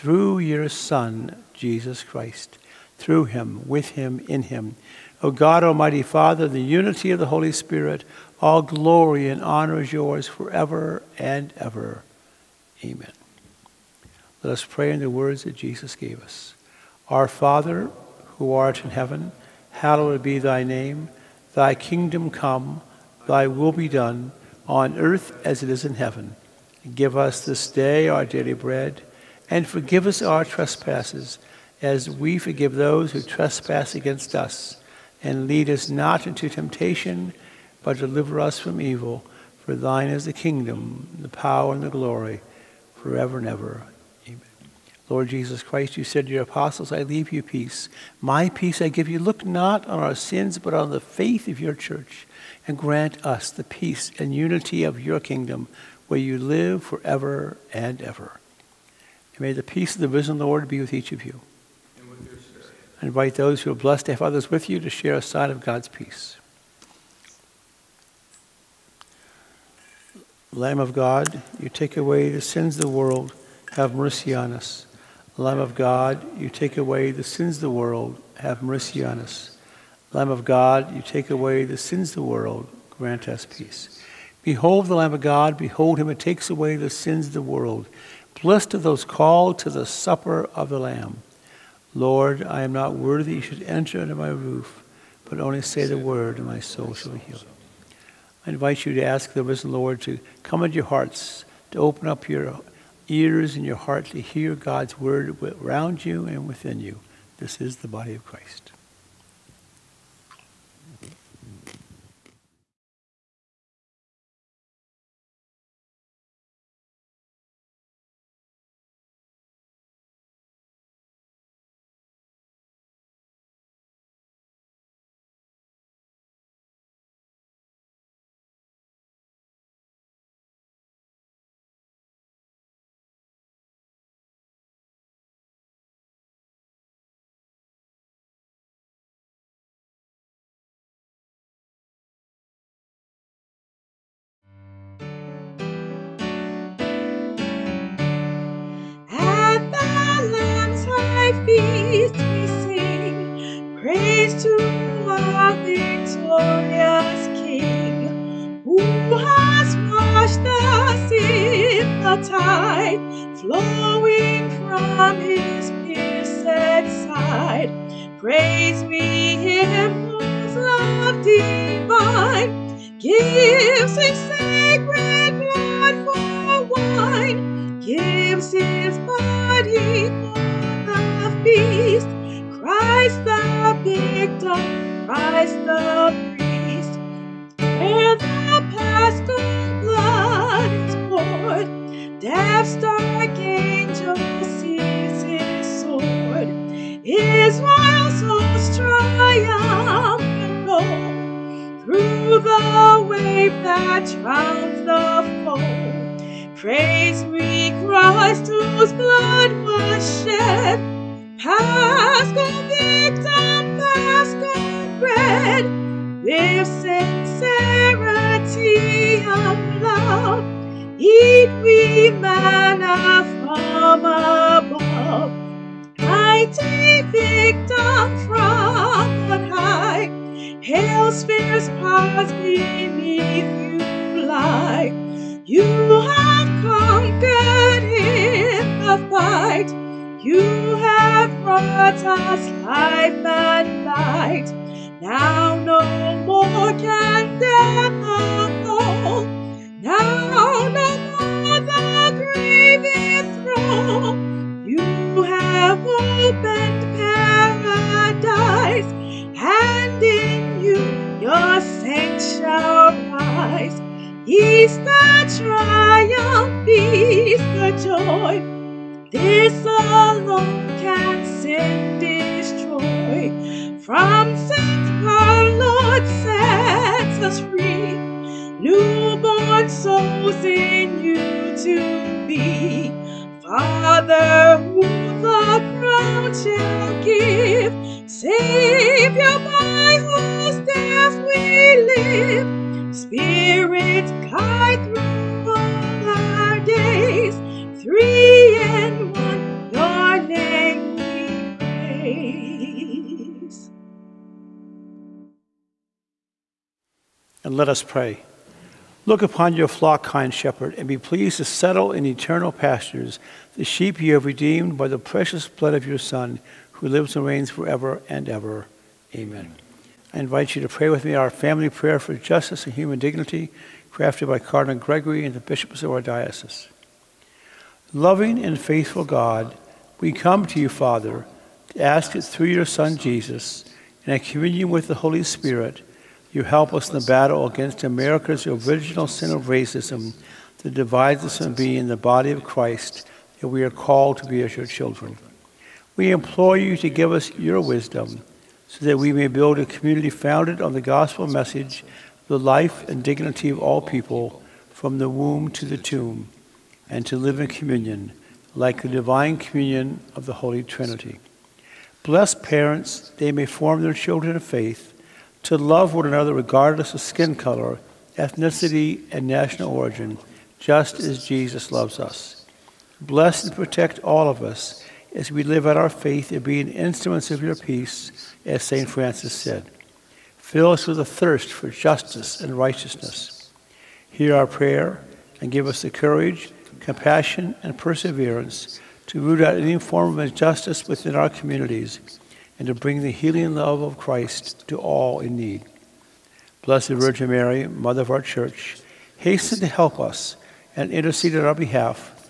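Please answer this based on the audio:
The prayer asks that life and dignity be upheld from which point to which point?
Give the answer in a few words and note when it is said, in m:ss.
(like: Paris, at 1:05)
the womb to the tomb, at 5:54.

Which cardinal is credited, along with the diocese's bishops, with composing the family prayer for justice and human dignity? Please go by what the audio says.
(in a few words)
Cardinal Gregory.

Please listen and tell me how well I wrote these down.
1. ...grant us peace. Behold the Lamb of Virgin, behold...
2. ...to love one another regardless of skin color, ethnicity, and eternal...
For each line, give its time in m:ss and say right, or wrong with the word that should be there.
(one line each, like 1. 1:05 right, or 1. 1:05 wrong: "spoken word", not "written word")
1. 1:22 wrong: "God", not "Virgin"
2. 6:05 wrong: "national", not "eternal".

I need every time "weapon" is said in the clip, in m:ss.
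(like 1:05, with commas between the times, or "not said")
not said.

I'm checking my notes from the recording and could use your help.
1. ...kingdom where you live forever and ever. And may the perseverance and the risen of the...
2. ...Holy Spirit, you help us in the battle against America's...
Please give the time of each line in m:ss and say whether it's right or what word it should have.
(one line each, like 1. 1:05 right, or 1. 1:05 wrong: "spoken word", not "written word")
1. 0:55 wrong: "peace", not "perseverance"
2. 5:34 right.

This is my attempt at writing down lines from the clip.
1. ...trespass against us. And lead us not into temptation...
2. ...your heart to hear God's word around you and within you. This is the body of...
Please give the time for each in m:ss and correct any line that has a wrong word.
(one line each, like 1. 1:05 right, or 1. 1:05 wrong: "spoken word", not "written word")
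1. 0:33 right
2. 1:43 right.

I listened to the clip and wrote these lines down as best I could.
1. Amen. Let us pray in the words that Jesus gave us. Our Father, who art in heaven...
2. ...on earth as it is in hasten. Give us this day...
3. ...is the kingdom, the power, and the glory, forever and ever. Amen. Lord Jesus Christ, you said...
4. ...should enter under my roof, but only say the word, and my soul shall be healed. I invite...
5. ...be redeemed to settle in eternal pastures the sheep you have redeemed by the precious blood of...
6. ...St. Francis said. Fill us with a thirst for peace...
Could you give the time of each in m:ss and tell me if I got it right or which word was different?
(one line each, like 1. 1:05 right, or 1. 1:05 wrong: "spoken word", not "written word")
1. 0:12 right
2. 0:24 wrong: "heaven", not "hasten"
3. 0:40 right
4. 1:33 right
5. 5:10 wrong: "pleased", not "redeemed"
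6. 6:18 wrong: "justice", not "peace".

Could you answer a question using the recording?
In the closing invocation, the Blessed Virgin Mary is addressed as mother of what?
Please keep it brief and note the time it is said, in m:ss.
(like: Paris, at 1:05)
our Church, at 6:37.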